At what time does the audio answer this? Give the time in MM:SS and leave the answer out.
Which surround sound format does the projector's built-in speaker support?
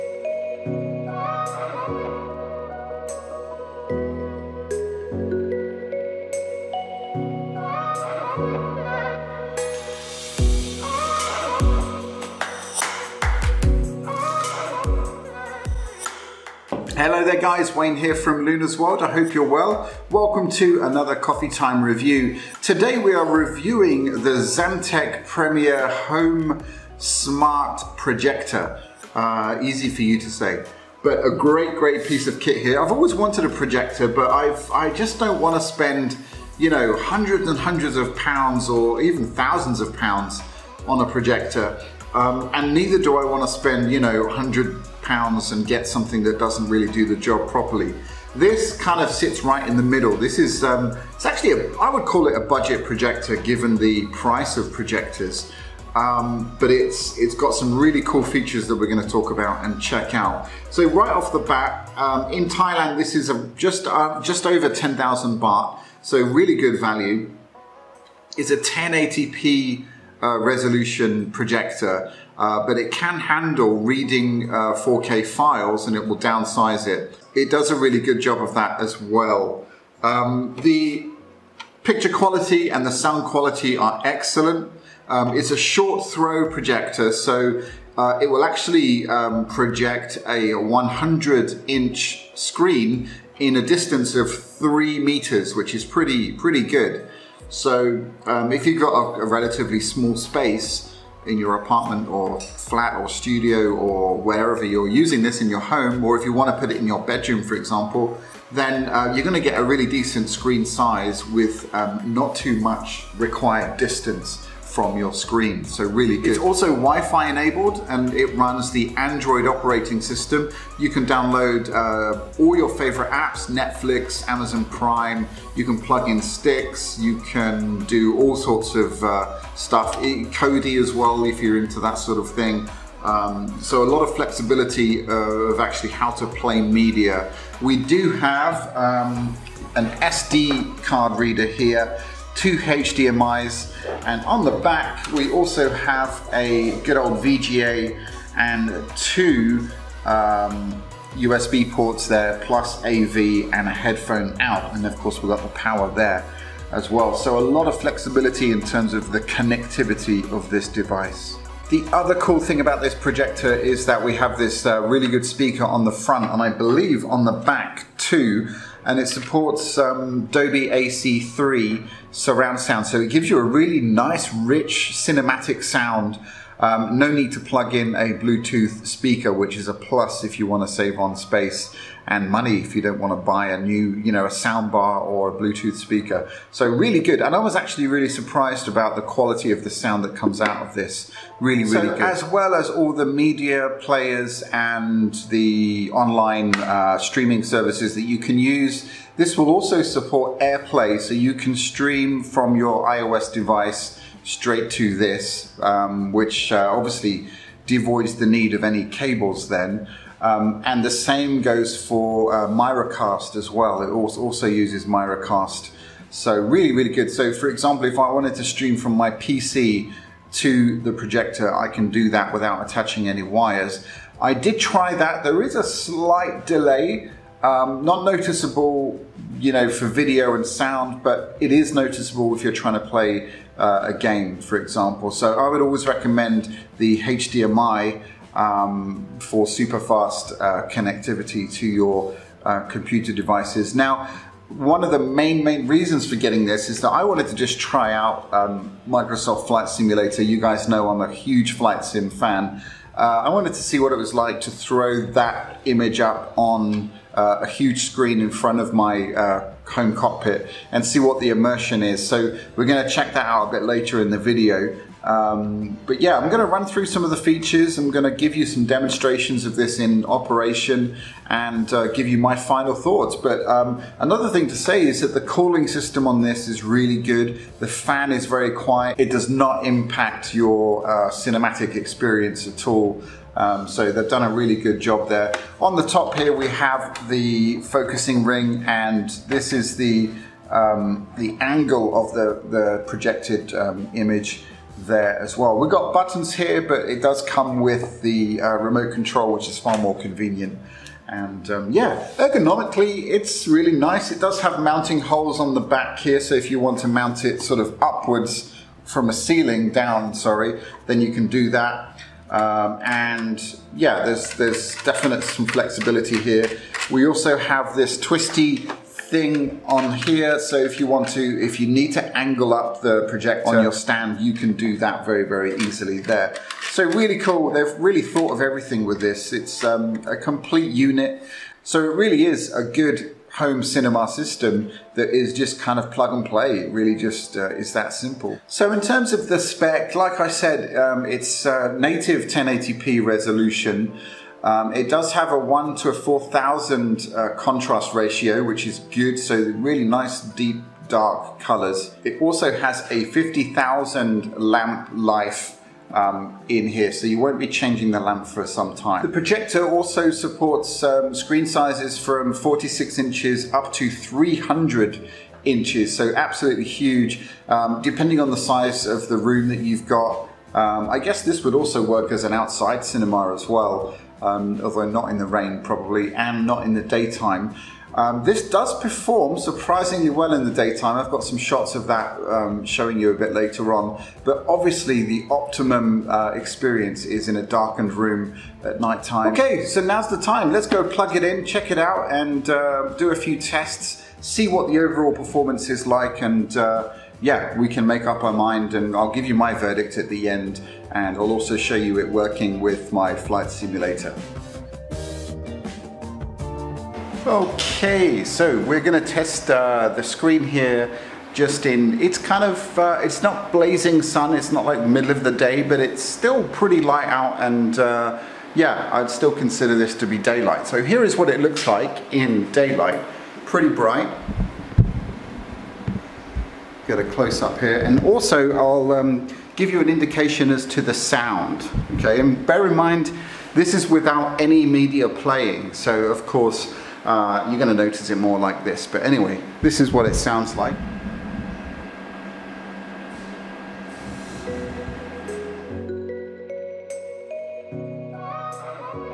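02:50.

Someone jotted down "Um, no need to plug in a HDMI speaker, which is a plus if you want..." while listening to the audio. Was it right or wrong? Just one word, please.
wrong.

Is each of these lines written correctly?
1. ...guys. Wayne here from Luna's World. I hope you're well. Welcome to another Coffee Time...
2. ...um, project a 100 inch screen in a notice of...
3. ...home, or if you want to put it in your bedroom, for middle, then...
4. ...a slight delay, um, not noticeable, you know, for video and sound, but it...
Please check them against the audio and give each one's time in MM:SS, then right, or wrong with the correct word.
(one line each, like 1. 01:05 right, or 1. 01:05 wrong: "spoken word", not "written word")
1. 00:17 right
2. 01:29 wrong: "distance", not "notice"
3. 01:45 wrong: "example", not "middle"
4. 03:45 right.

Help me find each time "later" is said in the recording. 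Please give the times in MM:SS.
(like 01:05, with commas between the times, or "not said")
04:23, 06:23.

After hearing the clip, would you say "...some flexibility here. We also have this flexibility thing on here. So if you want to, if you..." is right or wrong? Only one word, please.
wrong.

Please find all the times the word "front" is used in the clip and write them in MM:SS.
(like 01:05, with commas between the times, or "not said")
02:45, 04:18.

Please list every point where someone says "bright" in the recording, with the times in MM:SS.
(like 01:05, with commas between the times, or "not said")
07:03.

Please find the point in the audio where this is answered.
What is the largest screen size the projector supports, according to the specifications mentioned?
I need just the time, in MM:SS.
06:03.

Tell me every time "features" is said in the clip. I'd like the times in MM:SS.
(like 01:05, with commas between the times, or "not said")
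00:58, 04:27.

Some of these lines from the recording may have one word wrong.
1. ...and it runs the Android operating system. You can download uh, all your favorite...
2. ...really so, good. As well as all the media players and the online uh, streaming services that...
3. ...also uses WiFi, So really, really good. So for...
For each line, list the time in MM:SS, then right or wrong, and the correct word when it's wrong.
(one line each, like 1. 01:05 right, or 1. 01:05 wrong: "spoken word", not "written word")
1. 01:57 right
2. 03:11 right
3. 03:33 wrong: "Miracast", not "WiFi".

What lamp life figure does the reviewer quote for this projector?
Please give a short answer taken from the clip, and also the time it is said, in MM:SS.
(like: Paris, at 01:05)
50,000, at 05:53.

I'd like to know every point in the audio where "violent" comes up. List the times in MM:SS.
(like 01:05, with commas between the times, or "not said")
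not said.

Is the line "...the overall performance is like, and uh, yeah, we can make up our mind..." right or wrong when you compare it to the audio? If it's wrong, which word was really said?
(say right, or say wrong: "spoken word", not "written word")
right.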